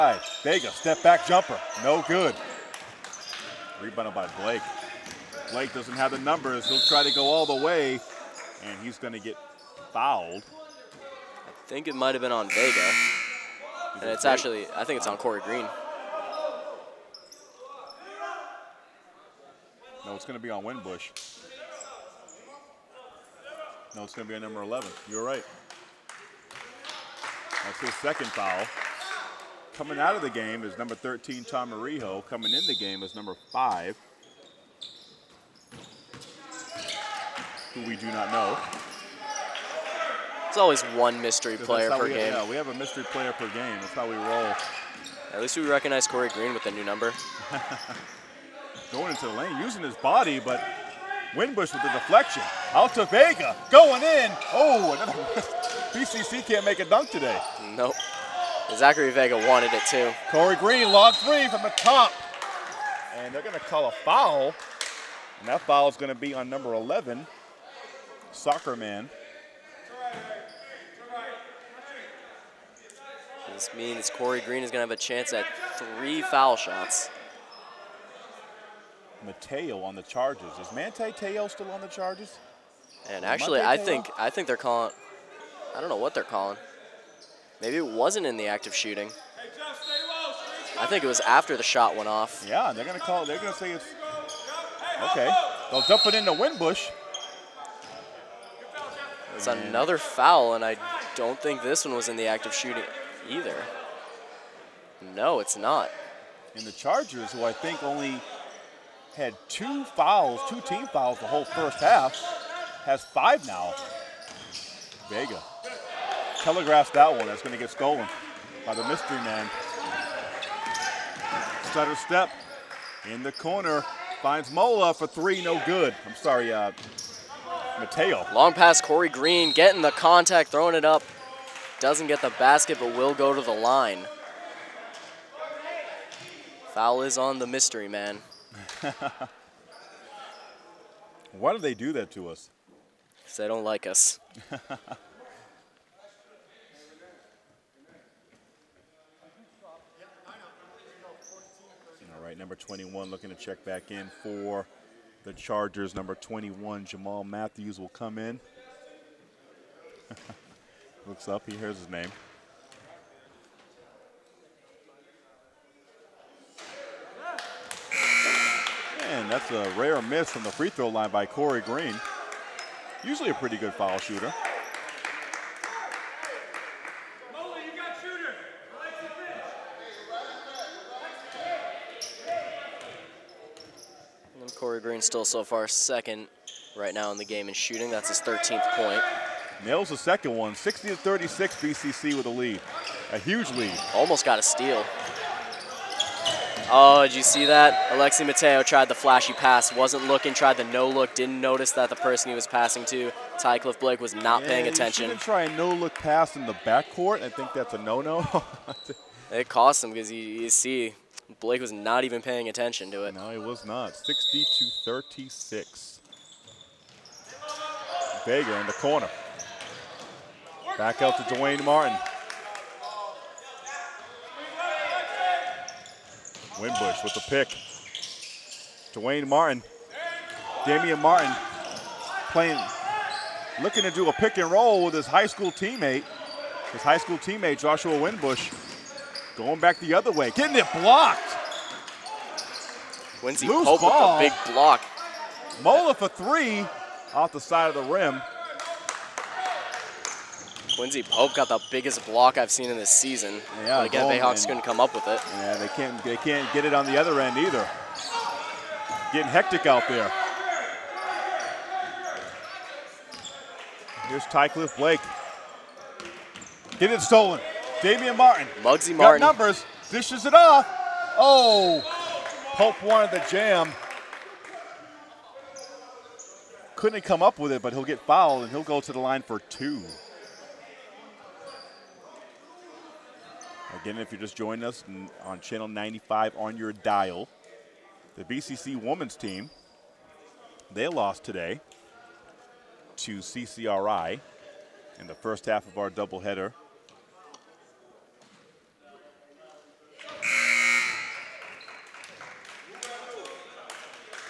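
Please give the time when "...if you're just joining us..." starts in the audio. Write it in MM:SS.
04:43.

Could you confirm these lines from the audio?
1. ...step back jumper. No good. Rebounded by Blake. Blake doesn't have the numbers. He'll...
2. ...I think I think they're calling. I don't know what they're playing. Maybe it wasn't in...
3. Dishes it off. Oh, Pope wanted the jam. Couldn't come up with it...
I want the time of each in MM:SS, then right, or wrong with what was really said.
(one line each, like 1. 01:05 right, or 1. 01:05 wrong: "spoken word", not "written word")
1. 00:00 right
2. 01:23 wrong: "calling", not "playing"
3. 04:29 right.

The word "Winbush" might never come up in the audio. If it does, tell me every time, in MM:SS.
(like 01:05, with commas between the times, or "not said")
00:20, 00:51, 01:36, 03:46, 03:57.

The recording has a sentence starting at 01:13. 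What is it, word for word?
This means Corey Green is going to have a chance at three foul shots.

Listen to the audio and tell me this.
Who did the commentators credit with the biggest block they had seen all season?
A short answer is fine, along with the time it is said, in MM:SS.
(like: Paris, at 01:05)
Quincy Pope, at 04:10.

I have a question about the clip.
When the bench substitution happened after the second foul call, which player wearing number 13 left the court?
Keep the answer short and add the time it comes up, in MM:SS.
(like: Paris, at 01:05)
Tommy Rijo, at 00:31.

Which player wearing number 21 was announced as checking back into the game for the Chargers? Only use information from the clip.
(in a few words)
Jamal Matthews.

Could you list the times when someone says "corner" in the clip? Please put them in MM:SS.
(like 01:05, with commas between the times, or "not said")
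02:03, 03:38.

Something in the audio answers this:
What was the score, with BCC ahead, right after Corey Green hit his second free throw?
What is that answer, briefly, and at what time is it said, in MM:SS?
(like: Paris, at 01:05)
60 to 36, at 03:10.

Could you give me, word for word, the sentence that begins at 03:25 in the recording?
He try a no-look pass in the backcourt.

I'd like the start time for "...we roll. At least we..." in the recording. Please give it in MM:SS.
00:44.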